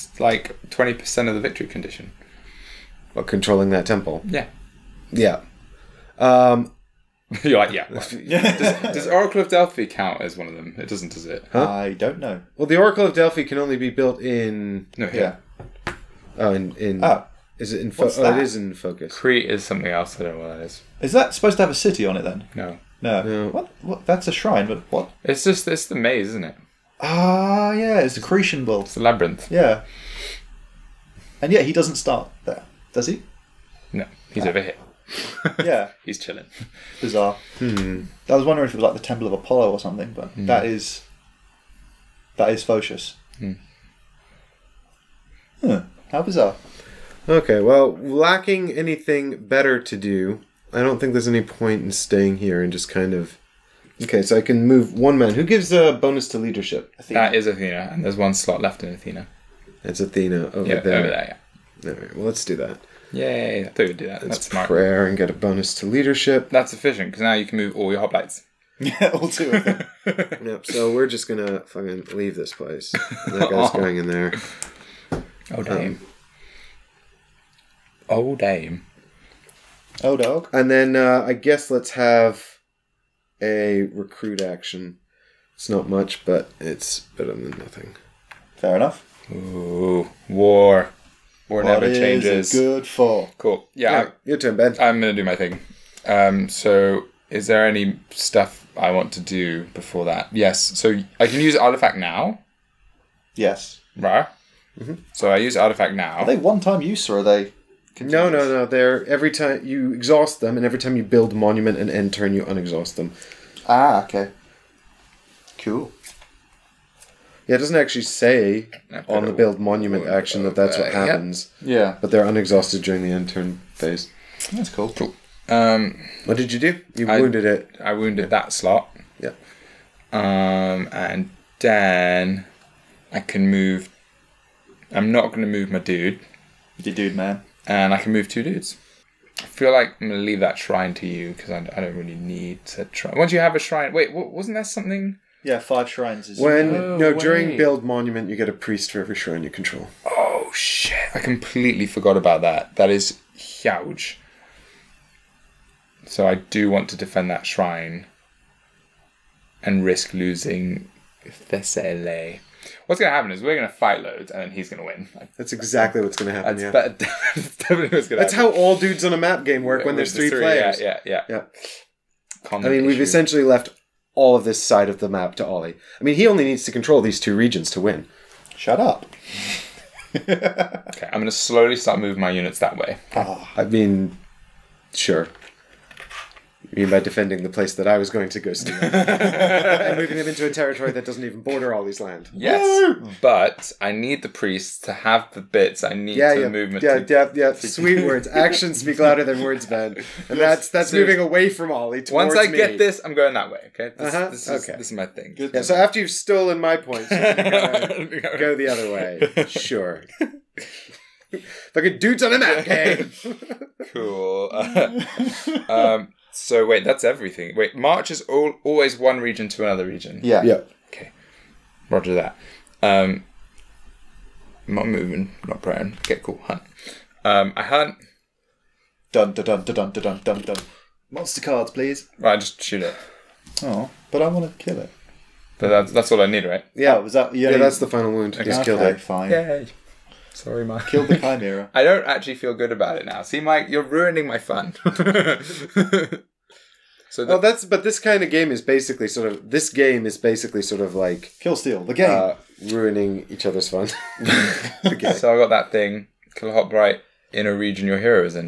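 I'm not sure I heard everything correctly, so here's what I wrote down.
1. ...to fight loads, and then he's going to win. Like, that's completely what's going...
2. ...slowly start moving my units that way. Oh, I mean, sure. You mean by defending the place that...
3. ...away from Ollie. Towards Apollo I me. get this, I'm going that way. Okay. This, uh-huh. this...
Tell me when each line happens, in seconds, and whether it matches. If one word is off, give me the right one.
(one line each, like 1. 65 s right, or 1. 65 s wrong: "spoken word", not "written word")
1. 163 s wrong: "exactly", not "completely"
2. 181 s right
3. 201 s wrong: "Once", not "Apollo".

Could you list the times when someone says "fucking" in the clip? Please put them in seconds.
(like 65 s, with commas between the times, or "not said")
71 s, 211 s.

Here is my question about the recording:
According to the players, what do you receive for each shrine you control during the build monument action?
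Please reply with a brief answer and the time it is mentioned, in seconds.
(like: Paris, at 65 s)
A priest, at 148 s.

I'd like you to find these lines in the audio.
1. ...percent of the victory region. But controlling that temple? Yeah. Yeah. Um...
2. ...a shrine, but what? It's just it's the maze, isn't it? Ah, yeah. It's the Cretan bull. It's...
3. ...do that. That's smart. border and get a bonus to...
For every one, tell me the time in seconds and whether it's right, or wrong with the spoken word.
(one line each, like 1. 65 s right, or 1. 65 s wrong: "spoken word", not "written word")
1. 0 s wrong: "condition", not "region"
2. 24 s right
3. 63 s wrong: "prayer", not "border".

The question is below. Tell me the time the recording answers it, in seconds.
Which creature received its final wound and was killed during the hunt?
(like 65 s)
240 s.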